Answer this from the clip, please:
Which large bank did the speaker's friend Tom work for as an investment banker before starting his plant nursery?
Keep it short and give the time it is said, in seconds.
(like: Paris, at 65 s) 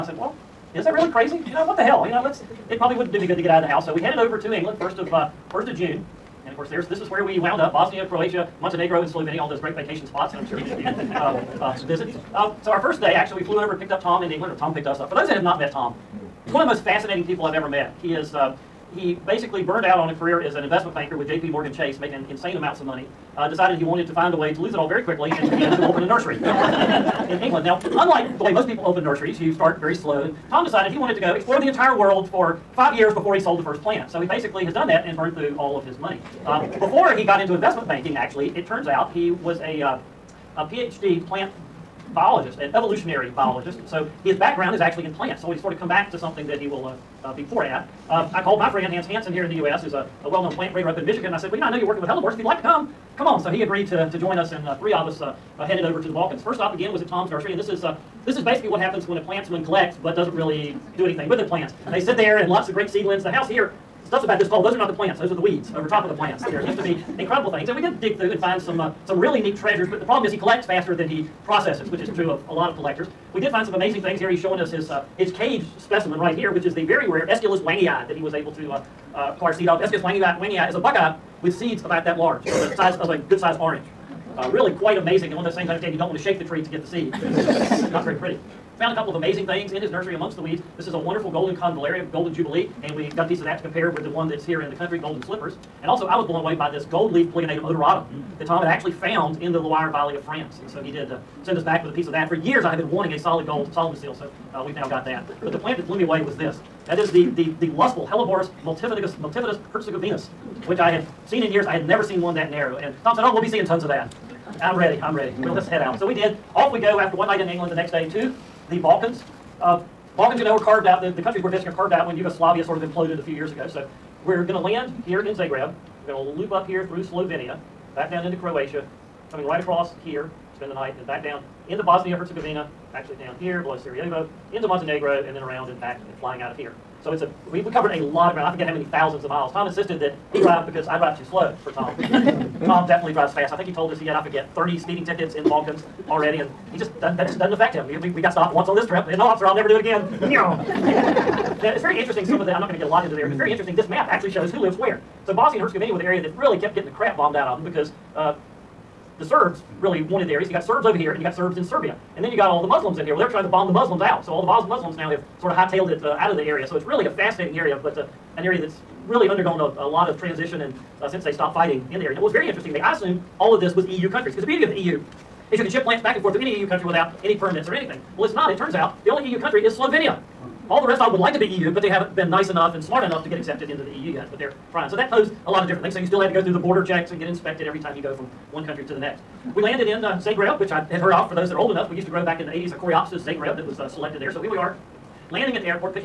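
JP Morgan Chase, at 21 s.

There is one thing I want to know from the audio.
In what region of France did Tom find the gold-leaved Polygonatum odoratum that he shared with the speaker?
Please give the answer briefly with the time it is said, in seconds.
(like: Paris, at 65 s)
Loire Valley, at 99 s.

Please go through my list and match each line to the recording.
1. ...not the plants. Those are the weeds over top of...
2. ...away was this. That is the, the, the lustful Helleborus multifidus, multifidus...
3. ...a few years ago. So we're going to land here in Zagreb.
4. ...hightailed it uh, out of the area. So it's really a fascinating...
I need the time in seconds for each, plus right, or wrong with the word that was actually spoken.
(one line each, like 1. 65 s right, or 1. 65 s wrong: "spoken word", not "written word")
1. 64 s right
2. 106 s right
3. 123 s right
4. 165 s right.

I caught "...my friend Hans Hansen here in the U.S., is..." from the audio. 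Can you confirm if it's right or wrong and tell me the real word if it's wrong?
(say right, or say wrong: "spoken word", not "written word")
right.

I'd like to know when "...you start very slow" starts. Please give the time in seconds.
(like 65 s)
29 s.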